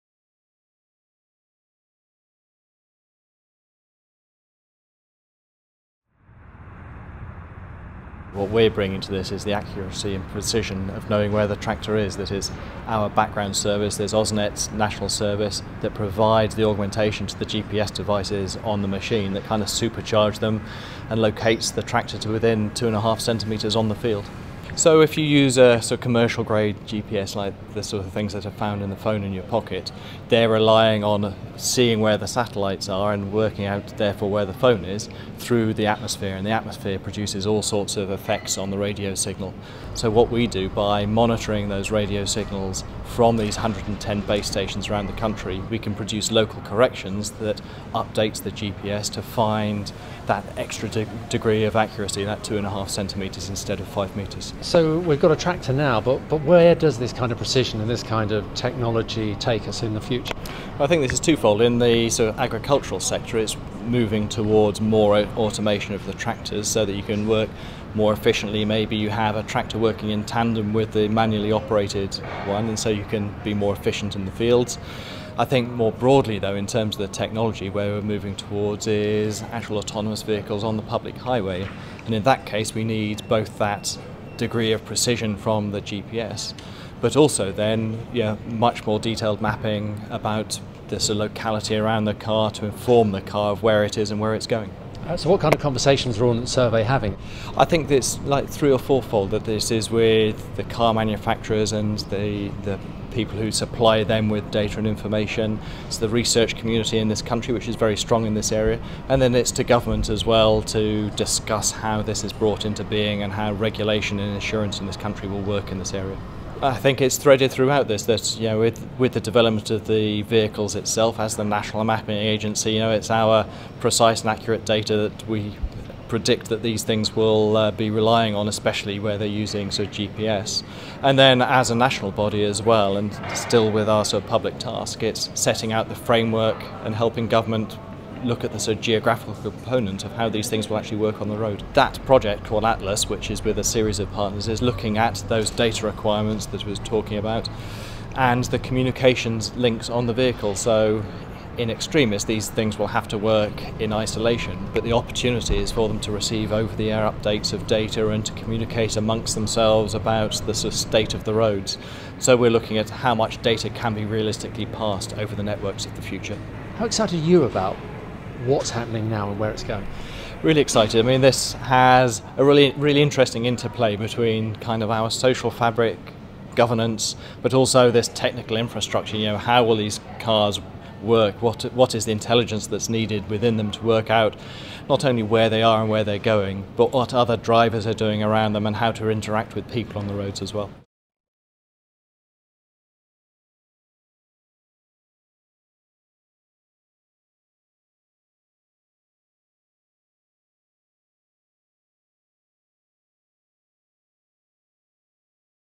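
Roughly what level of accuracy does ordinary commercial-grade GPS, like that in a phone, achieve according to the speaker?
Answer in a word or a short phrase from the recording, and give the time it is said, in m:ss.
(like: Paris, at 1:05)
5 metres, at 0:53.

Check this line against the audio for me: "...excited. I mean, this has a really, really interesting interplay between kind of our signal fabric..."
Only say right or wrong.
wrong.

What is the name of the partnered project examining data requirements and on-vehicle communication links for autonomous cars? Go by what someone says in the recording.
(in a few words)
Atlas.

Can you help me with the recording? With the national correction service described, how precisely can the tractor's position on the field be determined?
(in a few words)
2.5 centimetres.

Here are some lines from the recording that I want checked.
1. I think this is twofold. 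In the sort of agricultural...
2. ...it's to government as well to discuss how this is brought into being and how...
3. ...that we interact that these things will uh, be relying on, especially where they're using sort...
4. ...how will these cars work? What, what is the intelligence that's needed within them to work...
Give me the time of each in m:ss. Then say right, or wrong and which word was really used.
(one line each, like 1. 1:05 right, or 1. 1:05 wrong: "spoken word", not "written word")
1. 1:00 right
2. 1:49 right
3. 2:05 wrong: "predict", not "interact"
4. 2:59 right.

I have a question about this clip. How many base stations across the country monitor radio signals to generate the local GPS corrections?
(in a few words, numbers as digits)
110.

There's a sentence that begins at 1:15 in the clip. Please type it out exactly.
I think more broadly, though, in terms of the technology, where we're moving towards is actual autonomous vehicles on the public highway.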